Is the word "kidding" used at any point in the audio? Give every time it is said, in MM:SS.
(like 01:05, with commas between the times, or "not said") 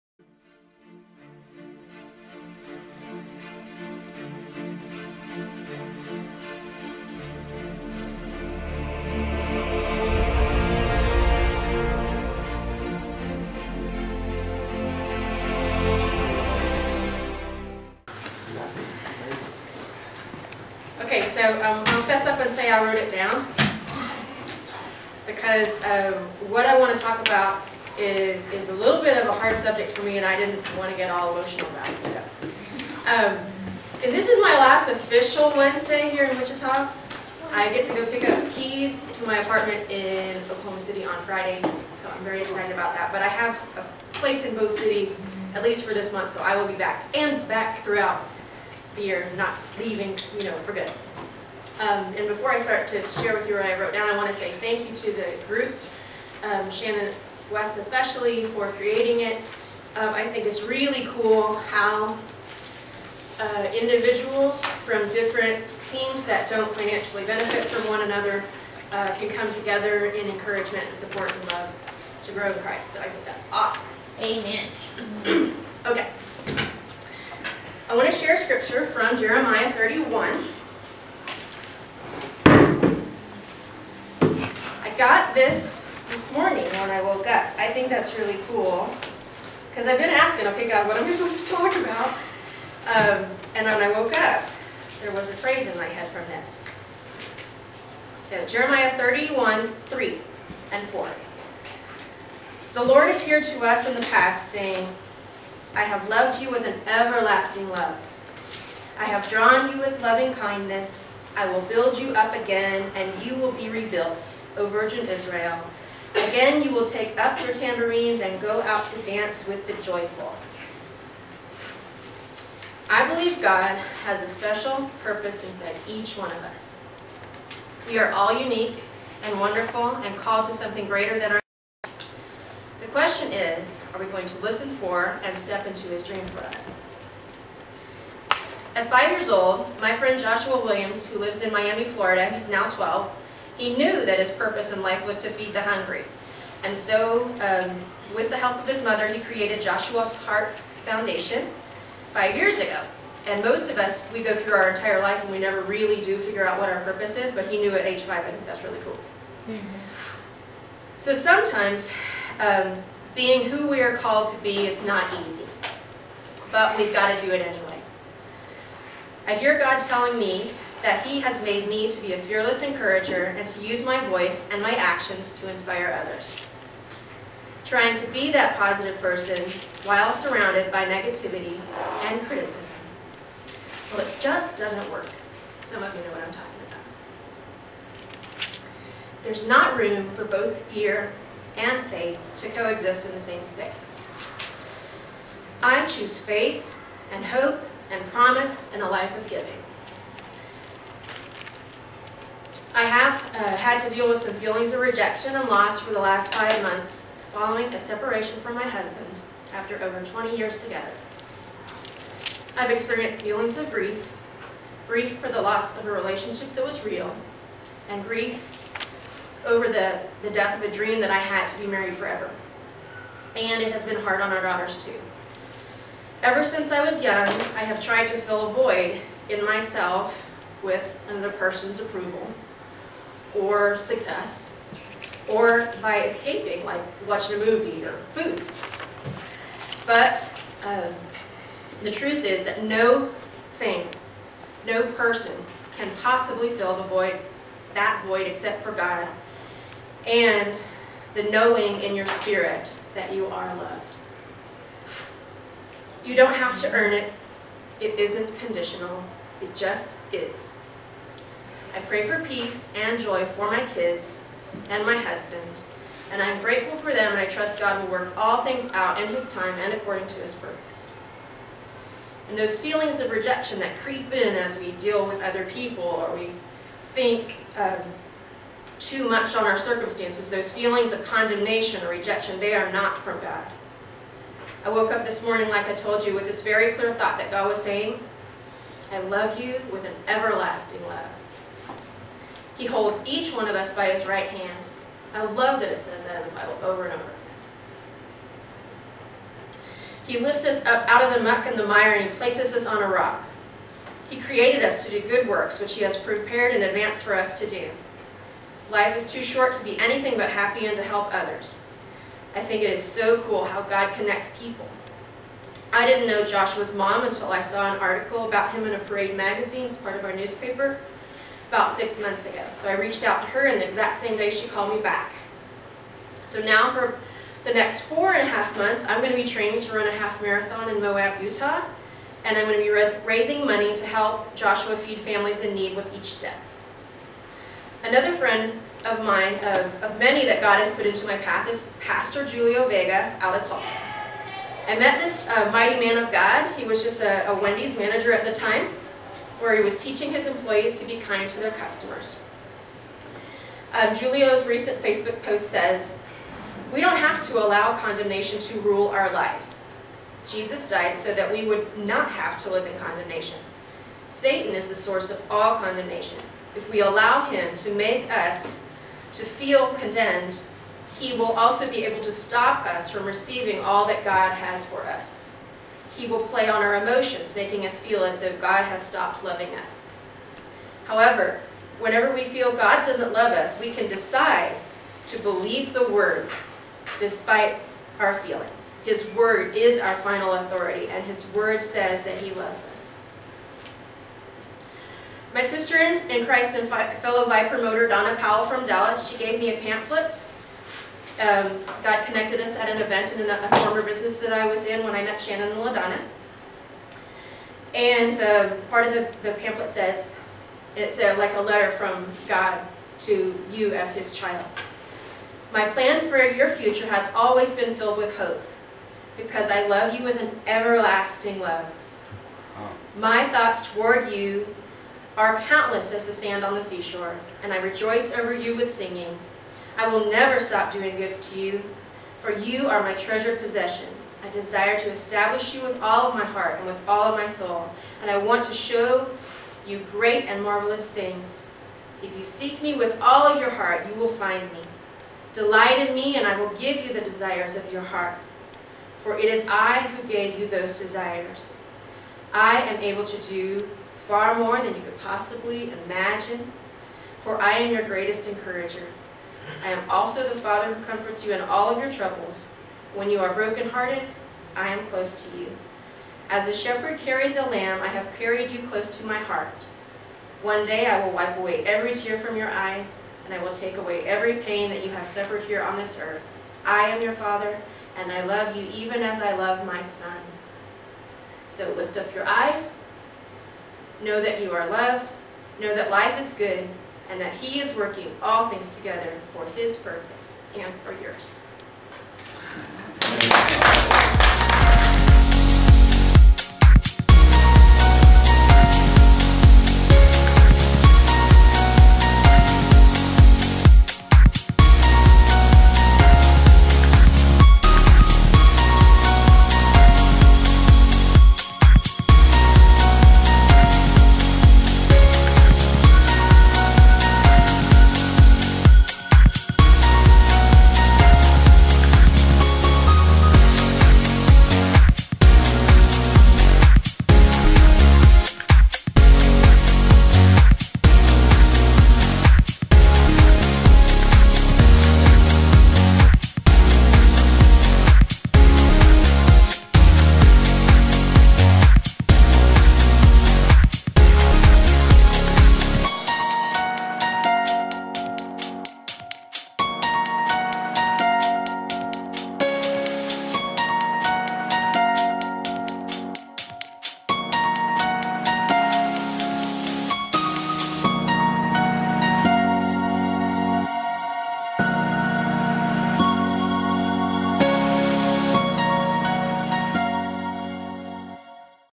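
not said.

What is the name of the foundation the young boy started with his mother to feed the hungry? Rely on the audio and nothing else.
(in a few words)
Joshua's Heart Foundation.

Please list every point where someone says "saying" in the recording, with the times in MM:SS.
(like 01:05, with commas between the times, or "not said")
01:44, 04:47.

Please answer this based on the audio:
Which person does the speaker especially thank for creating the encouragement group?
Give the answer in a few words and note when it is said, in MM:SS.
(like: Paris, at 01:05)
Shannon West, at 00:56.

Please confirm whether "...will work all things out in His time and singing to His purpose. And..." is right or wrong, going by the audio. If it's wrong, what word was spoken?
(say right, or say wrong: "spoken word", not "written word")
wrong: "according", not "singing".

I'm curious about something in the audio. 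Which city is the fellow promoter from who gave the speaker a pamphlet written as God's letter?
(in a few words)
Dallas.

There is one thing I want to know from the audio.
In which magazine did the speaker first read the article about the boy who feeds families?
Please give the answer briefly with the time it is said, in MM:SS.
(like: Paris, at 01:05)
Parade, at 05:18.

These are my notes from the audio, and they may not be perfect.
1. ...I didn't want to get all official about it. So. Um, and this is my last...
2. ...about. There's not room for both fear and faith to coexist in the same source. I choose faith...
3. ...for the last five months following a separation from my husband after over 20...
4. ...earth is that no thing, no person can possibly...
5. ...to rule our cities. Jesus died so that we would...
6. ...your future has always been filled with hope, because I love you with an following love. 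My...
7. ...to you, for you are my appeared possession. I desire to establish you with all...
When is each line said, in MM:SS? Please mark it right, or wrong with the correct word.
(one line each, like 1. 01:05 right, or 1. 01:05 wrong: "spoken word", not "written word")
1. 00:30 wrong: "emotional", not "official"
2. 03:08 wrong: "space", not "source"
3. 03:25 right
4. 04:01 wrong: "truth", not "earth"
5. 05:58 wrong: "lives", not "cities"
6. 06:56 wrong: "everlasting", not "following"
7. 07:11 wrong: "treasured", not "appeared".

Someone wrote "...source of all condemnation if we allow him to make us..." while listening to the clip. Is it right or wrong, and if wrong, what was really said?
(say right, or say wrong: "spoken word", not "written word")
right.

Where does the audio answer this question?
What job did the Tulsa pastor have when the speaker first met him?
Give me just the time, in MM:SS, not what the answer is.
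05:47.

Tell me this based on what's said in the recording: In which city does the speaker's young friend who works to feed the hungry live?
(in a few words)
Miami.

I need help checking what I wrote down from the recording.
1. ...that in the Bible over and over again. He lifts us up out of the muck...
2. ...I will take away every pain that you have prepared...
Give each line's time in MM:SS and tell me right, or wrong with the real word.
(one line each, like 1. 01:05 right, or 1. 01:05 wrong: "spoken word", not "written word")
1. 04:56 right
2. 07:53 wrong: "suffered", not "prepared".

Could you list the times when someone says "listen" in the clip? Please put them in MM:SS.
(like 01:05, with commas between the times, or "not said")
02:14.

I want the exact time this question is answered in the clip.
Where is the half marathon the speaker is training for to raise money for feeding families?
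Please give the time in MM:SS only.
05:30.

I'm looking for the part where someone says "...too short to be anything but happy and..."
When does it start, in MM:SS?
05:09.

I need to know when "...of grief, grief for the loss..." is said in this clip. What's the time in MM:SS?
03:33.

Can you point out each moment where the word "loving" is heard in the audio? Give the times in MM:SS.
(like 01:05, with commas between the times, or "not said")
01:50, 06:19.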